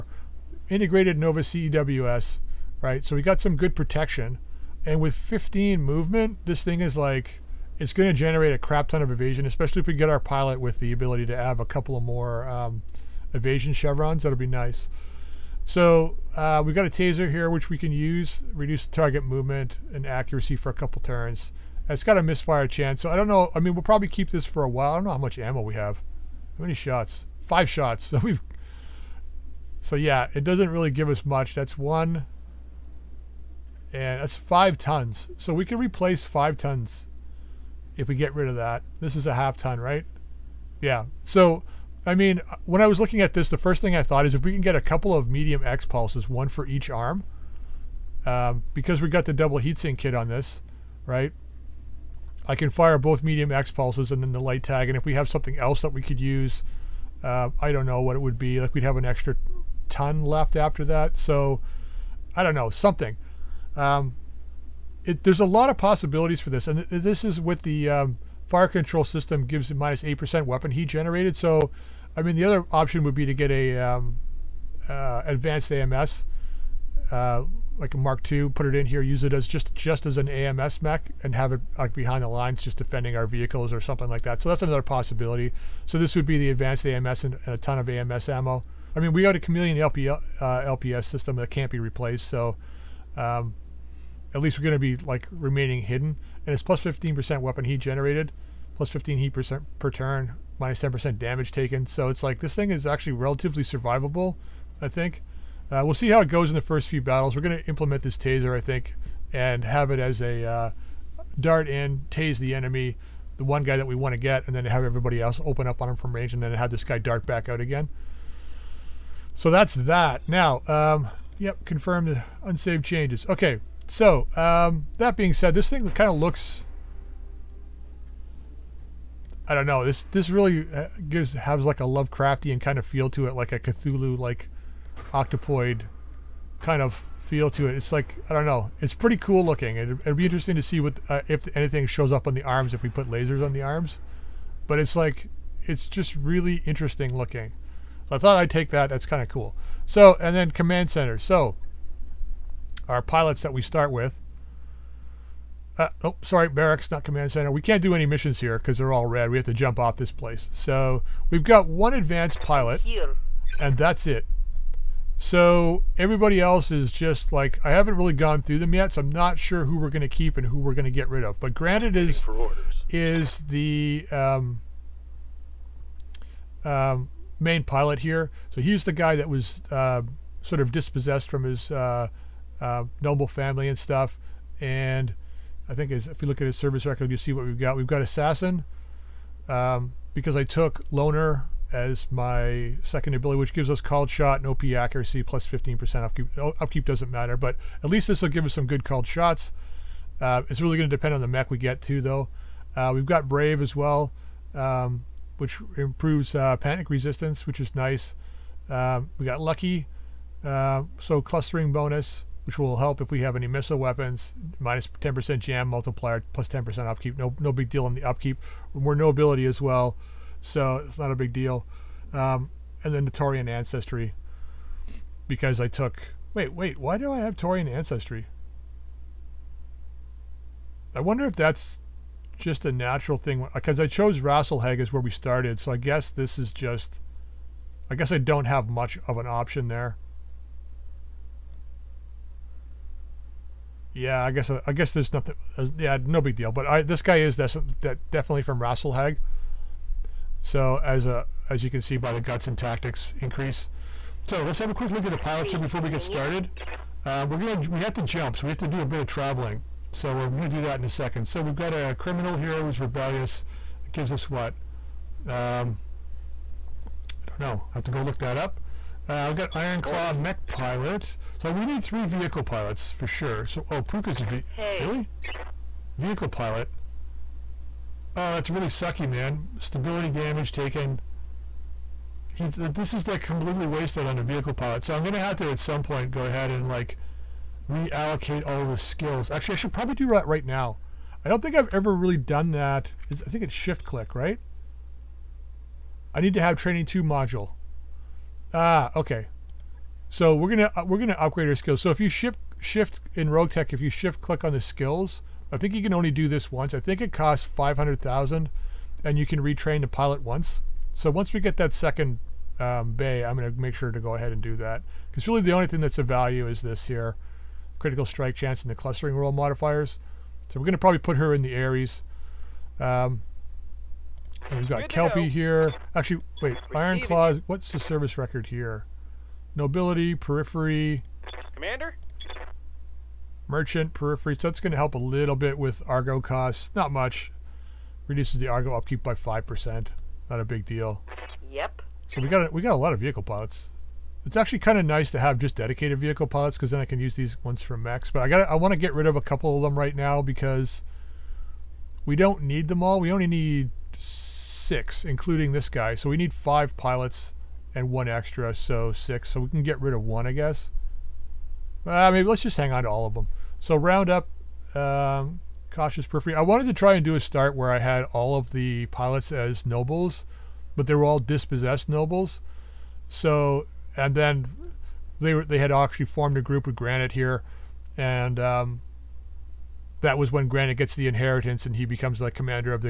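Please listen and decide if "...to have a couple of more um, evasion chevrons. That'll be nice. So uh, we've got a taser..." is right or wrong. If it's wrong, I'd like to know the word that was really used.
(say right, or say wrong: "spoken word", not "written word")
right.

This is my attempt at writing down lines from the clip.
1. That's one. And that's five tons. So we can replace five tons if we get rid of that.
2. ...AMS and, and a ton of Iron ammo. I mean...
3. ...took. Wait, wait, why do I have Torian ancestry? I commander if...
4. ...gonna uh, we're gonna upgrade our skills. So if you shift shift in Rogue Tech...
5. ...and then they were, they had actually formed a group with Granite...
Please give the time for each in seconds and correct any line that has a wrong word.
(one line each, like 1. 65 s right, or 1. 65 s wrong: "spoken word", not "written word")
1. 31 s right
2. 86 s wrong: "AMS", not "Iron"
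3. 225 s wrong: "wonder", not "commander"
4. 300 s right
5. 373 s right.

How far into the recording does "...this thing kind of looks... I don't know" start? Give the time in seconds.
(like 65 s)
125 s.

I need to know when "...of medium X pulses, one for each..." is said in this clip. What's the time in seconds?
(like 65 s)
45 s.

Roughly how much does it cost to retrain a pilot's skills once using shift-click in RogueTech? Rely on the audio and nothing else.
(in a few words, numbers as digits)
500,000.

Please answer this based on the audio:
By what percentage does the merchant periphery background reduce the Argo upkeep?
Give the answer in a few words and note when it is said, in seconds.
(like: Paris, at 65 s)
5%, at 339 s.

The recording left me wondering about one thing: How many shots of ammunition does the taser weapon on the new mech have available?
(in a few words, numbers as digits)
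5.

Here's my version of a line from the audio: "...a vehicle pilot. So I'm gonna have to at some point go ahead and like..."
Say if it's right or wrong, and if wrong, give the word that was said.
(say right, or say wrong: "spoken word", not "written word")
right.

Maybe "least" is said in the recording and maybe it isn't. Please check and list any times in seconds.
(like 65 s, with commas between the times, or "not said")
94 s, 197 s.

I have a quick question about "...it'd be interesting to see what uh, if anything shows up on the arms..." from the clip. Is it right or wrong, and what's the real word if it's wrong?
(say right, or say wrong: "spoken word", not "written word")
right.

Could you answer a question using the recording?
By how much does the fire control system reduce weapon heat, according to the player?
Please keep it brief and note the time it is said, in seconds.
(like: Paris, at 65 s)
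8 percent, at 69 s.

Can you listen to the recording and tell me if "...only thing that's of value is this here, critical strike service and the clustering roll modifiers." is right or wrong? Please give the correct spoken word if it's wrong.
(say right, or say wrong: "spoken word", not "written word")
wrong: "chance", not "service".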